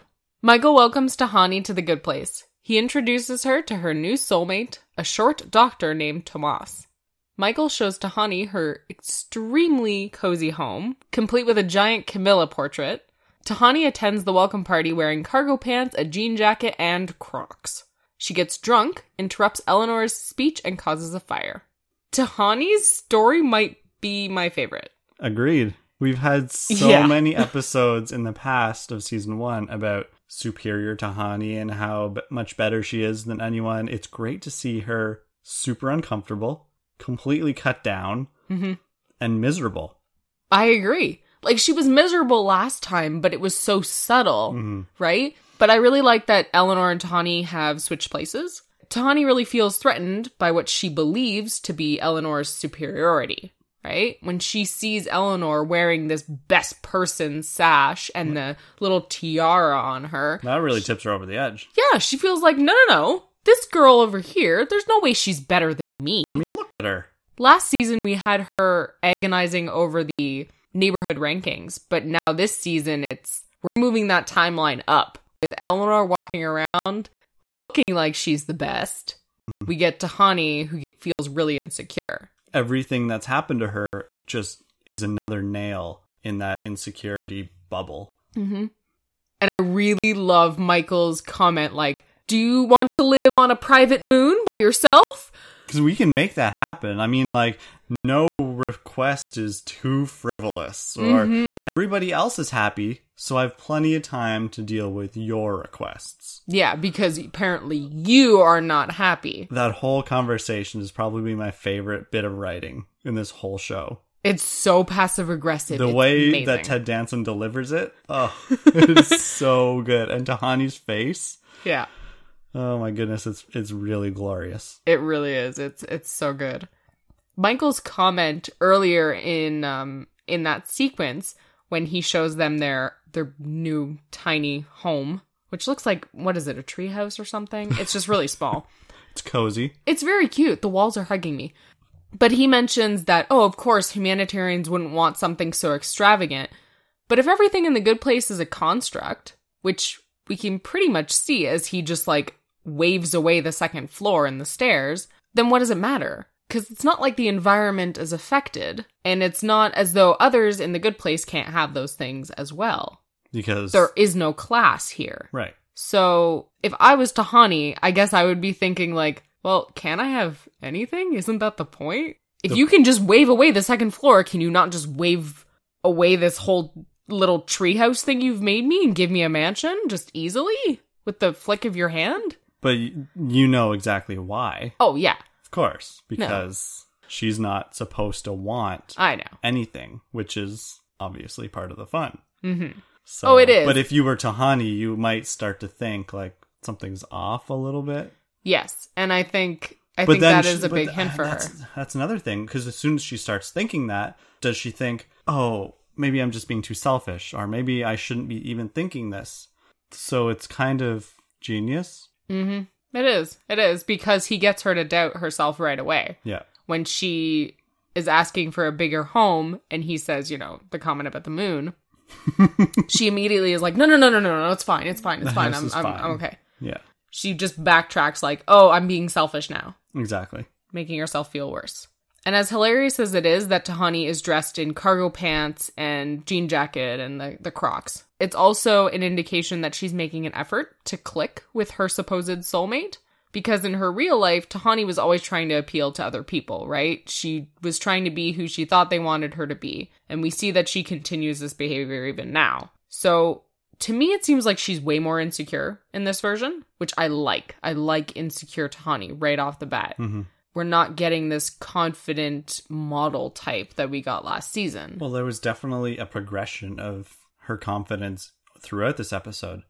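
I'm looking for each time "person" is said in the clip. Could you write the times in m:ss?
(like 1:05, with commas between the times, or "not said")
0:56.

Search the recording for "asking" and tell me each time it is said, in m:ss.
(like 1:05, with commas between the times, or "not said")
3:38.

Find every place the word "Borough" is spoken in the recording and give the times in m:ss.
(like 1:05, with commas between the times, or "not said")
not said.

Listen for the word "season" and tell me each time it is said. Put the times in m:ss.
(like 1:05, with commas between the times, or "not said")
0:29, 1:07, 1:12, 4:24.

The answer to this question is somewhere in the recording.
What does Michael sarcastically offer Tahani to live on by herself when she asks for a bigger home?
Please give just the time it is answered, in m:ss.
1:33.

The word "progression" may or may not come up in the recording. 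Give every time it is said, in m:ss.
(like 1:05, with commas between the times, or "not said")
4:26.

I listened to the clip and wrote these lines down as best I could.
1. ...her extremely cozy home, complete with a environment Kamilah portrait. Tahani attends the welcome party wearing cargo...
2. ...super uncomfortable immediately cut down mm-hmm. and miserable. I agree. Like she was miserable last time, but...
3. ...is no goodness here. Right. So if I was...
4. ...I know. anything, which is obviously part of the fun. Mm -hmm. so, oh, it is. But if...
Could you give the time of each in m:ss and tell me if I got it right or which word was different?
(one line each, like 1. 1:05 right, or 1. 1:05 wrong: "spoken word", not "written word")
1. 0:08 wrong: "giant", not "environment"
2. 0:35 wrong: "completely", not "immediately"
3. 2:43 wrong: "class", not "goodness"
4. 3:08 right.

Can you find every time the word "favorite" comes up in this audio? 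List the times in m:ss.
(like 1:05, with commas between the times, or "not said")
0:24, 1:51.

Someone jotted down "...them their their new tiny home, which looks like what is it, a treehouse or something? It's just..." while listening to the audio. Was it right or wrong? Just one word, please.
right.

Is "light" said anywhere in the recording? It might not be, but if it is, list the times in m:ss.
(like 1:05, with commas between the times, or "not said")
not said.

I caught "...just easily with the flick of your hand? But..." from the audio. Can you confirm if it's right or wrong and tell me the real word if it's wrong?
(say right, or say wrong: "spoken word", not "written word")
right.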